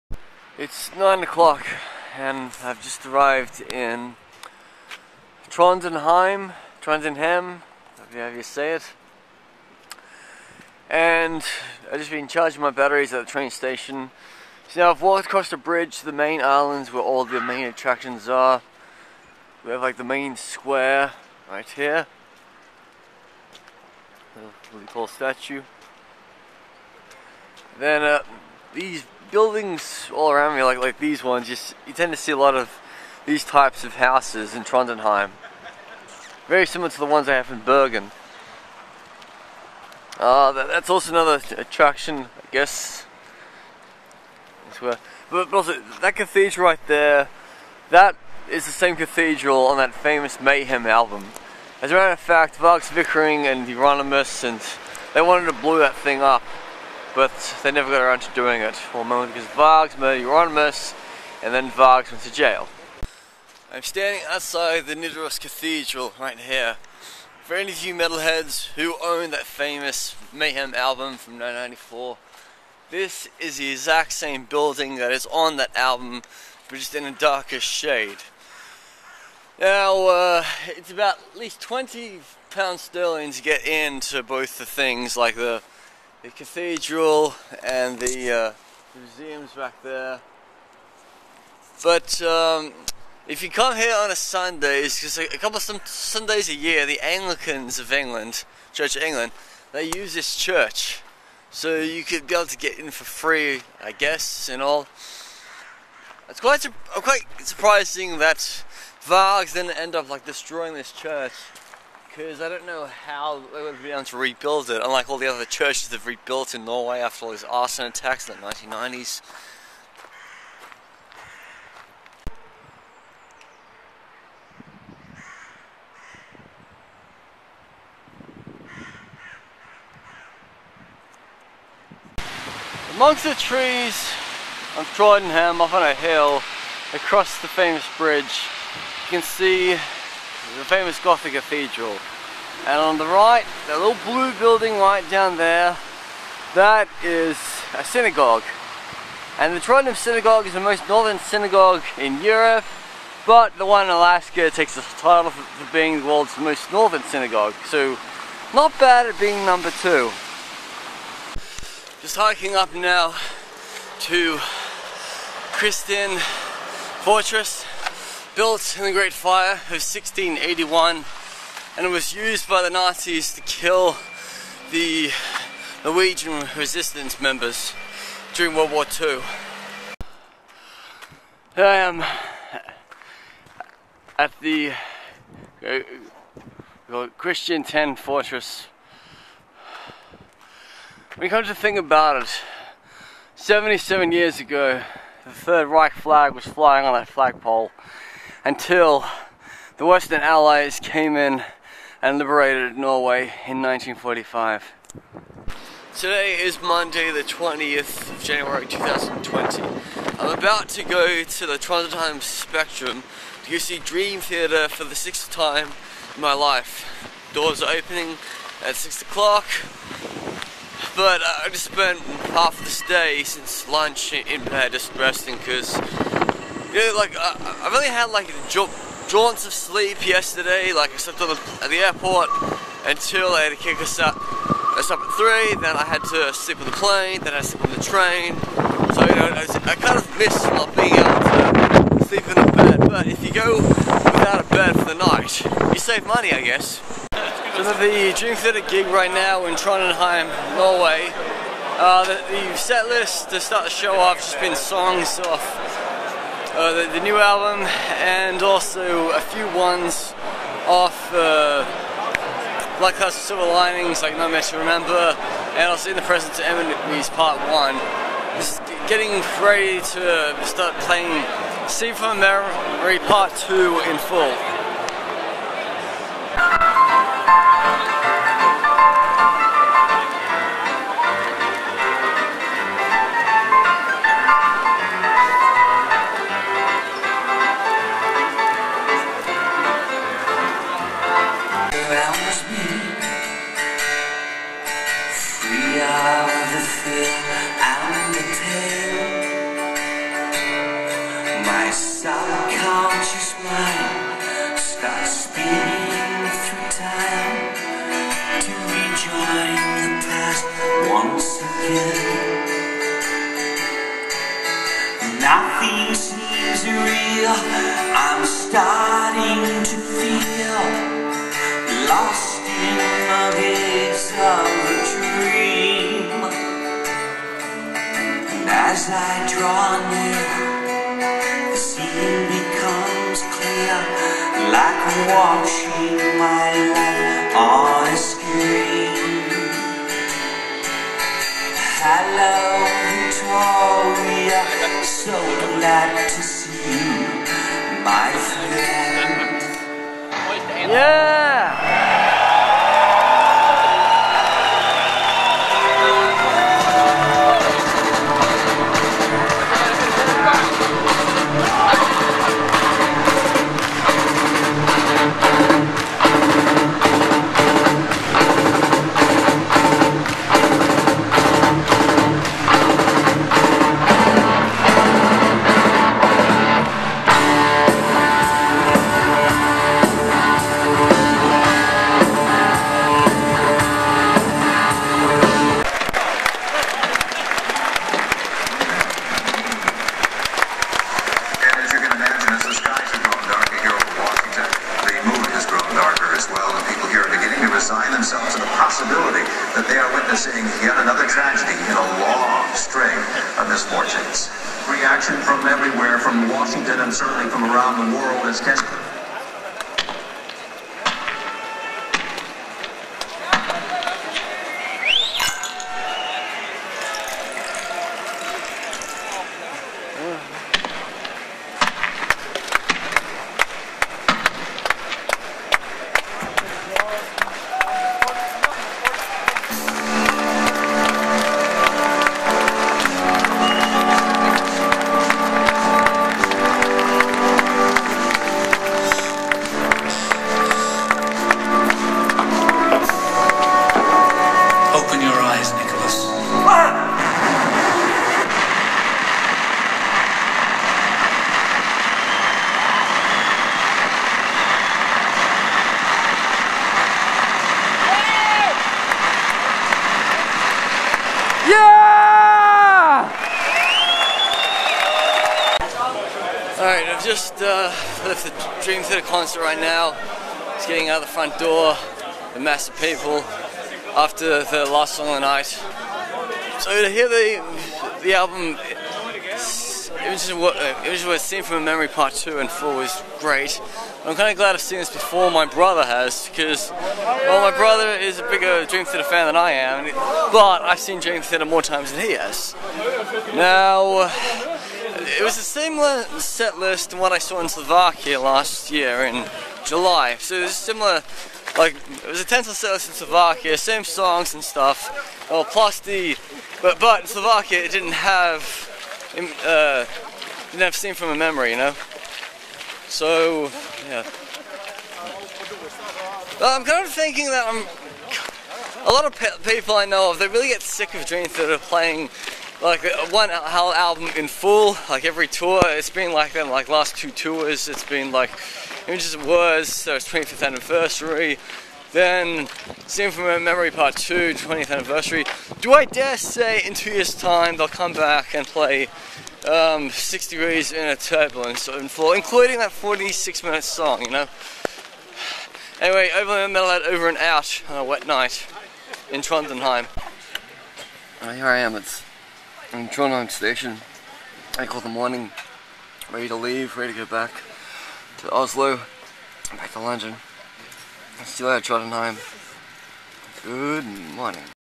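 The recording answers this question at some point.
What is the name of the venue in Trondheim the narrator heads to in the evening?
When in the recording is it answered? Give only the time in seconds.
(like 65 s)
211 s.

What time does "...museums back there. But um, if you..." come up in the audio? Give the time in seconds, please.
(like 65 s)
88 s.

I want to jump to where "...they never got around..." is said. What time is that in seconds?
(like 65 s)
57 s.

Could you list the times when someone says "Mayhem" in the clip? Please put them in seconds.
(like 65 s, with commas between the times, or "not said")
50 s, 70 s.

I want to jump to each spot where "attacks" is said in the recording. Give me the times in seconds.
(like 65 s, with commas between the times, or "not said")
117 s.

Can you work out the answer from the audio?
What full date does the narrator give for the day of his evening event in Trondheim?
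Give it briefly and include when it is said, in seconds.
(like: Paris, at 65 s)
Monday 20 January 2020, at 206 s.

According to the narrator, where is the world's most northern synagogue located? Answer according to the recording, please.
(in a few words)
Alaska.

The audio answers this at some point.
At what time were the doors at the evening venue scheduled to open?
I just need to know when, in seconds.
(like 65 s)
218 s.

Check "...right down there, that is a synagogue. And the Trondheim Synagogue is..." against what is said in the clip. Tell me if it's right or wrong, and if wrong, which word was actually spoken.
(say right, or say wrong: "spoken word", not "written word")
right.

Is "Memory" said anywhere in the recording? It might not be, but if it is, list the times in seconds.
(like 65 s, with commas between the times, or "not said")
272 s, 481 s, 511 s, 533 s.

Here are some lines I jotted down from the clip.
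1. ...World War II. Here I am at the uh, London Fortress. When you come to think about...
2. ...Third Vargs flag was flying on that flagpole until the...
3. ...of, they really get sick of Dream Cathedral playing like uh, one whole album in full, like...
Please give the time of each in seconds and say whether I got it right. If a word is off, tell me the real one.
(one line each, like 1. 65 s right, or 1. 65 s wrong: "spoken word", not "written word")
1. 178 s wrong: "Kristiansten", not "London"
2. 195 s wrong: "Reich", not "Vargs"
3. 520 s wrong: "Theater", not "Cathedral".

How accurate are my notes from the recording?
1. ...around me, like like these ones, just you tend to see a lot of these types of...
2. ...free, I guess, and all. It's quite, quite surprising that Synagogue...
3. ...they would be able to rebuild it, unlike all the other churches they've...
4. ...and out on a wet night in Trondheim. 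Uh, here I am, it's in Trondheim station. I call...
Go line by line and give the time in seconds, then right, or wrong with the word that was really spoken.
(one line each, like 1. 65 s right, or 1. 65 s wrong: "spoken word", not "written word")
1. 30 s right
2. 103 s wrong: "Vargs", not "Synagogue"
3. 113 s right
4. 547 s right.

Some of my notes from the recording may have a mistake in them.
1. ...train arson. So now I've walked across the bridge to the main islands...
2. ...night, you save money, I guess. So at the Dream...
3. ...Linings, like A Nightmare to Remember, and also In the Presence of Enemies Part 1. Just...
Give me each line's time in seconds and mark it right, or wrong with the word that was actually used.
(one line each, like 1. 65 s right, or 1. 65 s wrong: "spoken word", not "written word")
1. 13 s wrong: "station", not "arson"
2. 244 s right
3. 263 s right.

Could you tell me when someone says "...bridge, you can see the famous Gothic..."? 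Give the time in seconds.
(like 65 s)
137 s.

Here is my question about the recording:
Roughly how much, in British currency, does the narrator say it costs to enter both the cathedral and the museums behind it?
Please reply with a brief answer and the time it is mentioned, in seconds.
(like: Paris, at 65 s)
20 pounds sterling, at 81 s.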